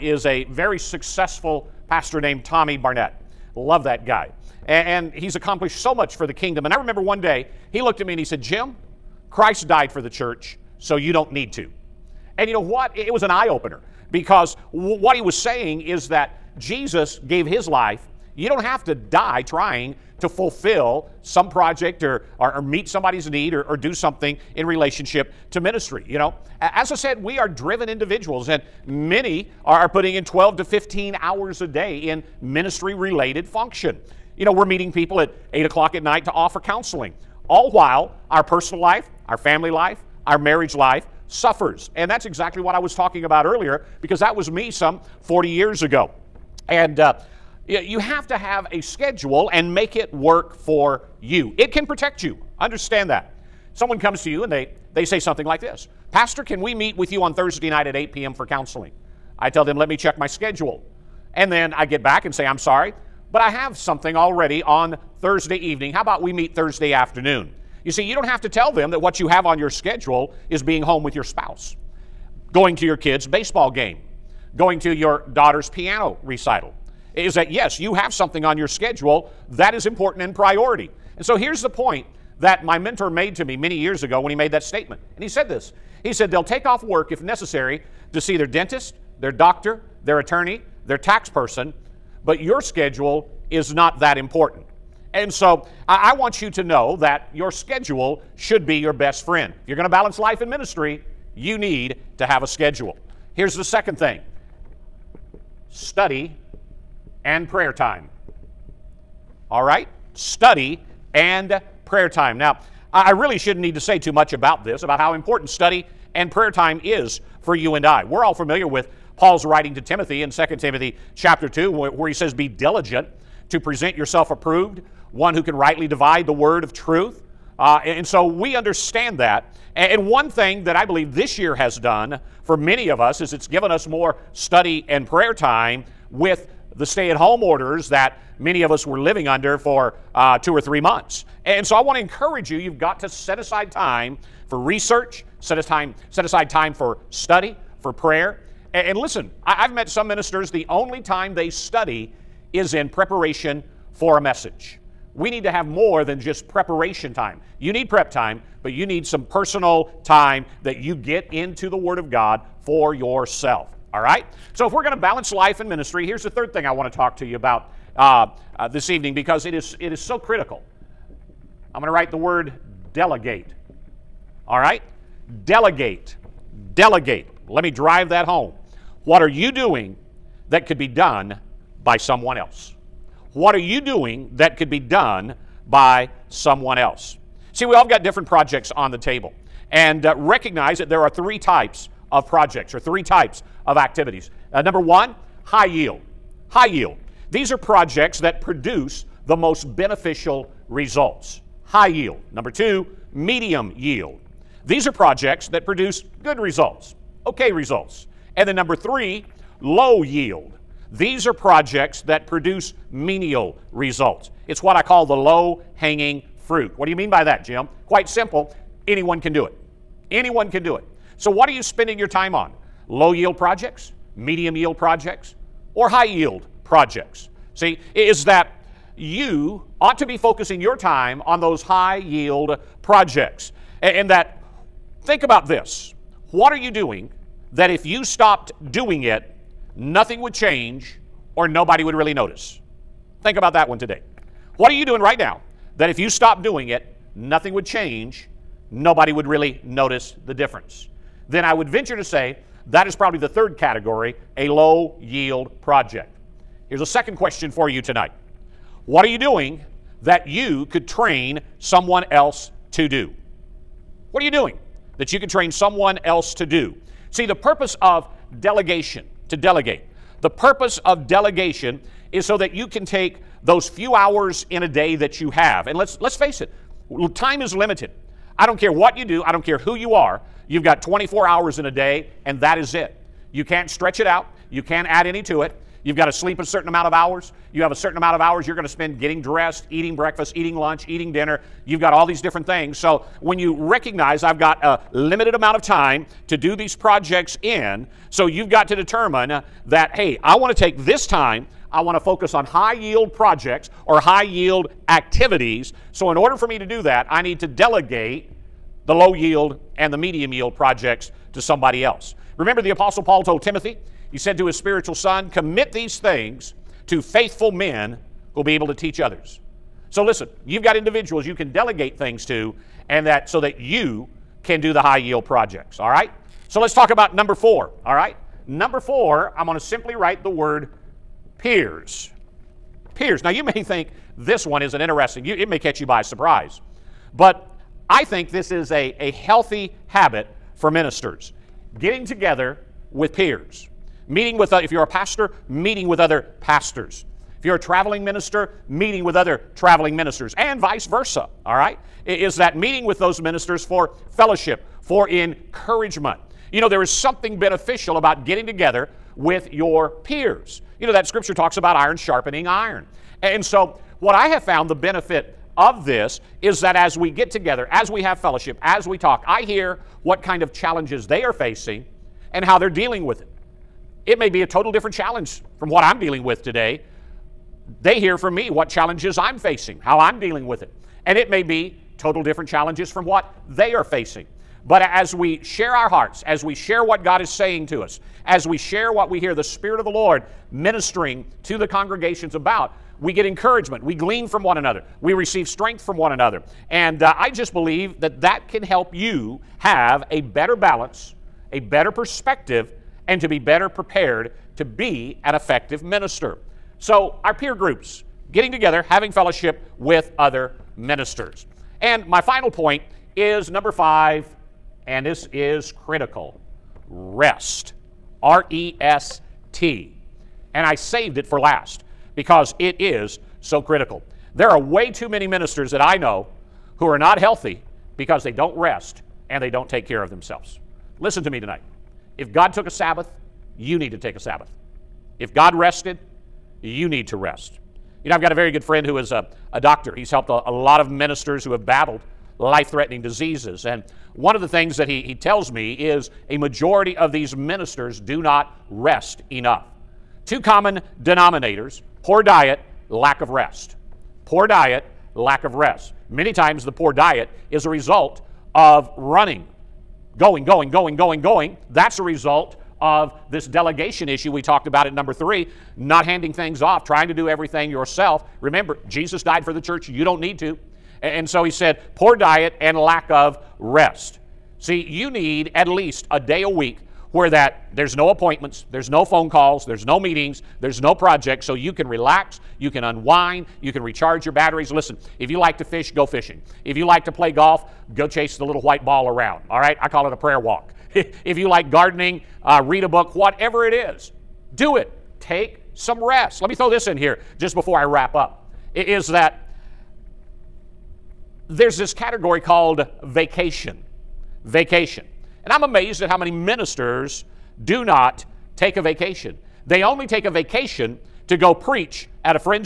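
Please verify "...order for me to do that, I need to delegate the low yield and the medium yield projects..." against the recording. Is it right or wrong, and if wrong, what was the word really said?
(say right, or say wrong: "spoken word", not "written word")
right.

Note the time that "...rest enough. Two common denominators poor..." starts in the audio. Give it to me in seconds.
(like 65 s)
448 s.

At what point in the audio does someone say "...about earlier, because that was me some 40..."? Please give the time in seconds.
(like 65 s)
43 s.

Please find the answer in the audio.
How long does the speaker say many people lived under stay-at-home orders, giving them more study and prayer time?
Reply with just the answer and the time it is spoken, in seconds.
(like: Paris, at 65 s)
Two or three months, at 140 s.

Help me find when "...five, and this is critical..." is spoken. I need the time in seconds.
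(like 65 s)
413 s.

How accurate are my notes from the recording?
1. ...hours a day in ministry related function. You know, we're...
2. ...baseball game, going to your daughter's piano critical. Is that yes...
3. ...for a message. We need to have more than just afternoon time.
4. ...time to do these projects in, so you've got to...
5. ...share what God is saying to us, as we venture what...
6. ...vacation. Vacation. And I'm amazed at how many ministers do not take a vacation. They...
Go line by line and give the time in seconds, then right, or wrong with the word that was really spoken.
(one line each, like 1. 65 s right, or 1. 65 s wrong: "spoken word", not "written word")
1. 31 s right
2. 73 s wrong: "recital", not "critical"
3. 153 s wrong: "preparation", not "afternoon"
4. 295 s right
5. 386 s wrong: "share", not "venture"
6. 503 s right.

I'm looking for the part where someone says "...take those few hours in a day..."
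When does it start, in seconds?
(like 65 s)
272 s.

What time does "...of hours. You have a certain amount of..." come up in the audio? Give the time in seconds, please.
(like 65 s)
286 s.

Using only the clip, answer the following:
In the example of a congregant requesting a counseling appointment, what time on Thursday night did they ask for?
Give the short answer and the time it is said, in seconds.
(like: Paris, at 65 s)
8 p.m., at 57 s.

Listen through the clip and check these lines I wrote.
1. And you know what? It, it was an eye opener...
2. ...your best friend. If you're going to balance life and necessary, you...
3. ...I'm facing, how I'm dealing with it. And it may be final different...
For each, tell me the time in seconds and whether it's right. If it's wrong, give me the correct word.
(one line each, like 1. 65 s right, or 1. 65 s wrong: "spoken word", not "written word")
1. 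12 s right
2. 98 s wrong: "ministry", not "necessary"
3. 379 s wrong: "total", not "final".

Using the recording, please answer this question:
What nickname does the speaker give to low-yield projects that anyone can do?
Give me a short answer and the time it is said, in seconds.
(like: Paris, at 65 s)
Low hanging fruit, at 215 s.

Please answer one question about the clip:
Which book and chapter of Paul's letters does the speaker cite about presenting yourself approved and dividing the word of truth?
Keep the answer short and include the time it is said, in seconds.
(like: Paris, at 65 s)
2 Timothy chapter 2, at 120 s.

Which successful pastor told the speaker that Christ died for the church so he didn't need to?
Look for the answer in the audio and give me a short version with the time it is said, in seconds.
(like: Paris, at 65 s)
Tommy Barnett, at 2 s.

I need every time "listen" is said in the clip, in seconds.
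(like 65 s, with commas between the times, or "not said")
148 s, 320 s, 430 s, 484 s.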